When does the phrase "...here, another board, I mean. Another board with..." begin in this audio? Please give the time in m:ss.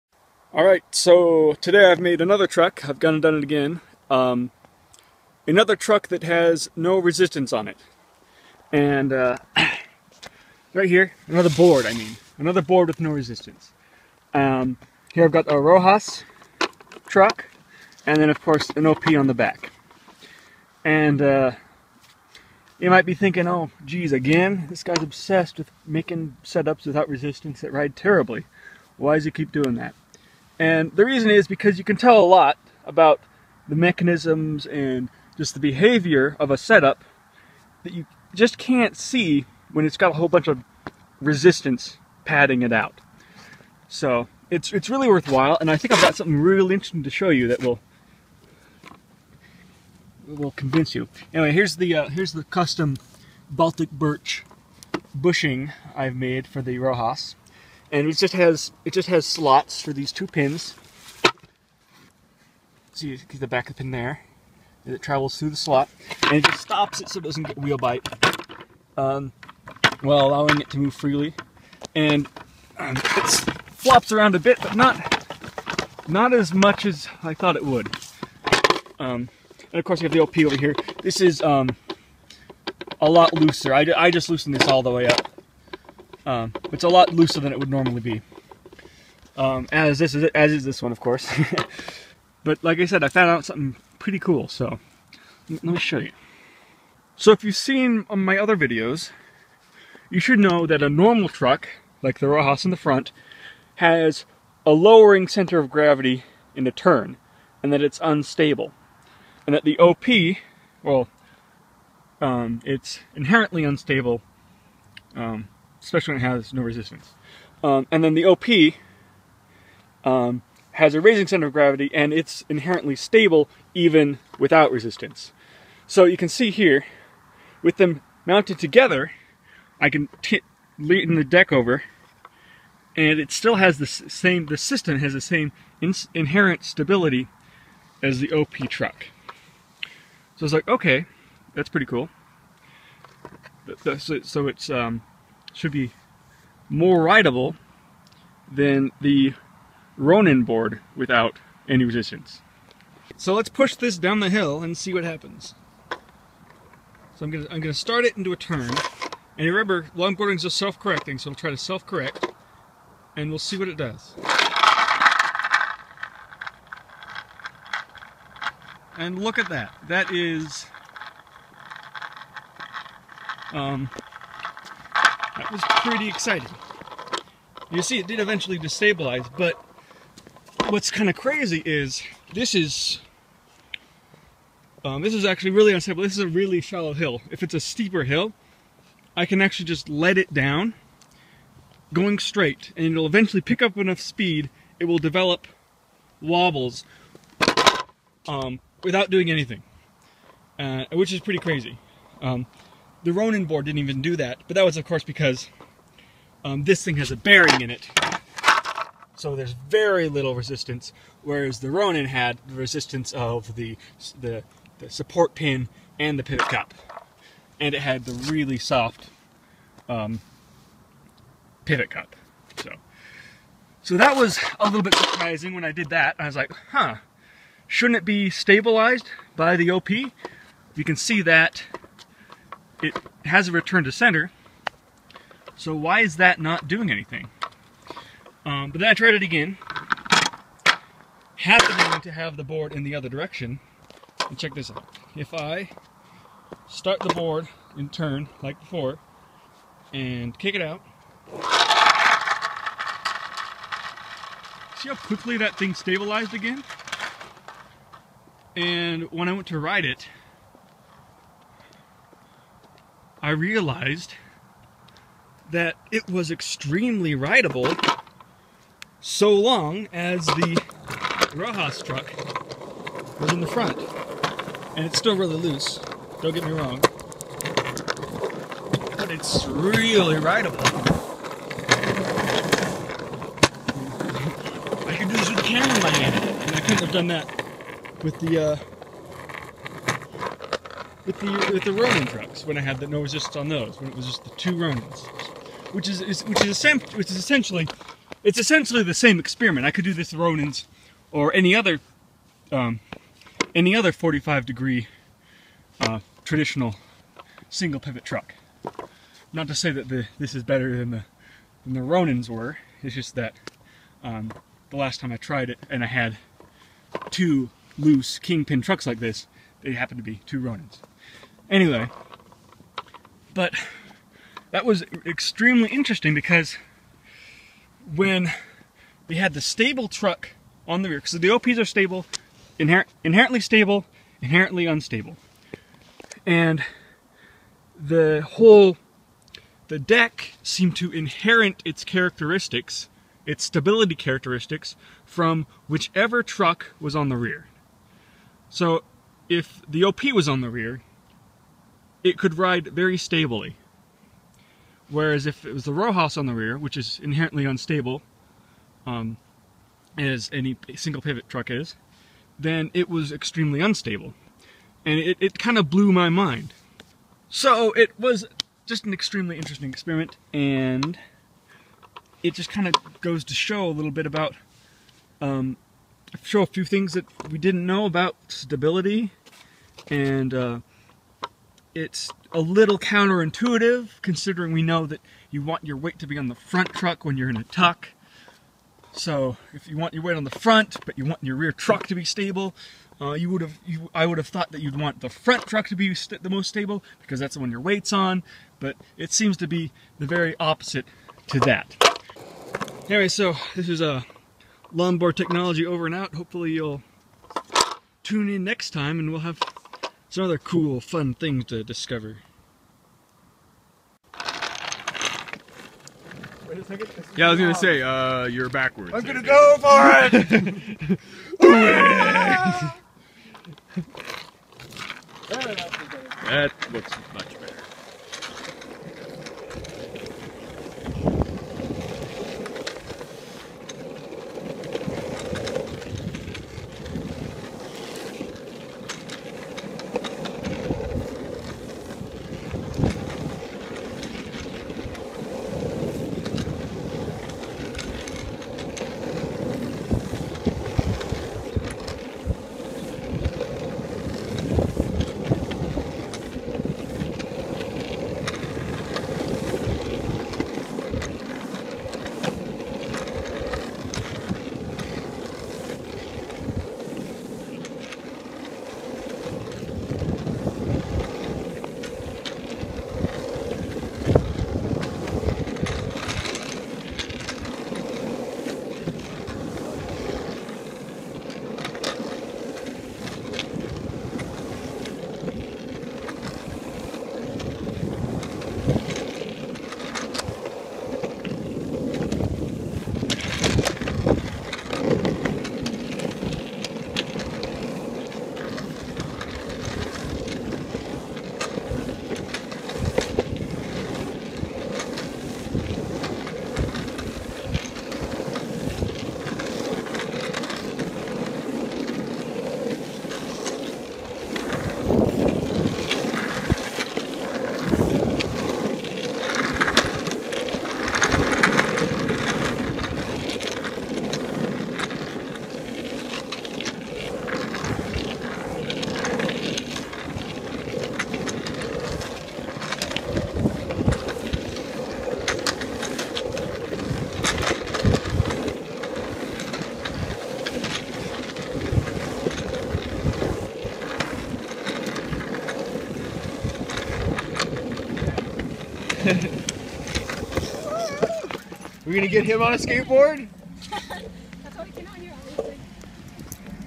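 0:10.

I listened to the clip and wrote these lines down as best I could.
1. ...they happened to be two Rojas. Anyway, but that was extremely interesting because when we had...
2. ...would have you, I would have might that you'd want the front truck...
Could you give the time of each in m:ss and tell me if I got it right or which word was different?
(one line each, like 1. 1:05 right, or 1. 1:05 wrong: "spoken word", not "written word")
1. 5:19 wrong: "Ronins", not "Rojas"
2. 6:33 wrong: "thought", not "might".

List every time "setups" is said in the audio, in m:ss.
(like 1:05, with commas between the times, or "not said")
0:26, 0:36.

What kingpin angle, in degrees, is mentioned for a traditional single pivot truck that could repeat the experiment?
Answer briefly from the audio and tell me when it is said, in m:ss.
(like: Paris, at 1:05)
45, at 5:03.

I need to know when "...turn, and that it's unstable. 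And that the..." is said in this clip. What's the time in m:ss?
1:46.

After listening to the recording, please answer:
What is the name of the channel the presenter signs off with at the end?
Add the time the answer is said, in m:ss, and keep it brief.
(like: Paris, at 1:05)
Longboard Technology, at 6:44.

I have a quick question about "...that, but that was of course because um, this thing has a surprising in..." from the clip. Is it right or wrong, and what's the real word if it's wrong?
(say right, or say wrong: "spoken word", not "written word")
wrong: "bearing", not "surprising".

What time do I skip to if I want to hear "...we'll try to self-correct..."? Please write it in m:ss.
2:41.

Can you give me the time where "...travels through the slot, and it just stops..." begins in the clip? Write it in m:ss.
1:05.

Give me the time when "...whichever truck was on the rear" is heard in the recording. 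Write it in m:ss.
5:45.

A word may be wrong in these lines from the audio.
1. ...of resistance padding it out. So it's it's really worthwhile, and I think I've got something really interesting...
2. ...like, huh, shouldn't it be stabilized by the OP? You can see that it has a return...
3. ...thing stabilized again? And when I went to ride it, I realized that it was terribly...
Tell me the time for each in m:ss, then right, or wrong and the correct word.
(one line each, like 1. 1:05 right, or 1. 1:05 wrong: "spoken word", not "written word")
1. 0:40 right
2. 3:46 right
3. 4:15 wrong: "extremely", not "terribly".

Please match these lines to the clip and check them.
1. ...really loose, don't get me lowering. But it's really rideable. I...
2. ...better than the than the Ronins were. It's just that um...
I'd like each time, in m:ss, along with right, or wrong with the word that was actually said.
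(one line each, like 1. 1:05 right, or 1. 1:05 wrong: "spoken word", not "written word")
1. 4:35 wrong: "wrong", not "lowering"
2. 5:10 right.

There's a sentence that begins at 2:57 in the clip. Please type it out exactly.
You see, it did eventually destabilize, but what's kind of crazy is this is um, this is actually really unstable.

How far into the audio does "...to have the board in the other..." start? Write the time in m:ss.
4:02.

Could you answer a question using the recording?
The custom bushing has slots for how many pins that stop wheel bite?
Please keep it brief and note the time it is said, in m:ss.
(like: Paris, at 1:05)
2, at 1:00.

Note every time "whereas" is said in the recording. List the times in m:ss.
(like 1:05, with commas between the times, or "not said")
3:31, 5:54.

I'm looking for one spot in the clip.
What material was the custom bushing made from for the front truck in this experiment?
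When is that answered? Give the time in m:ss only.
0:53.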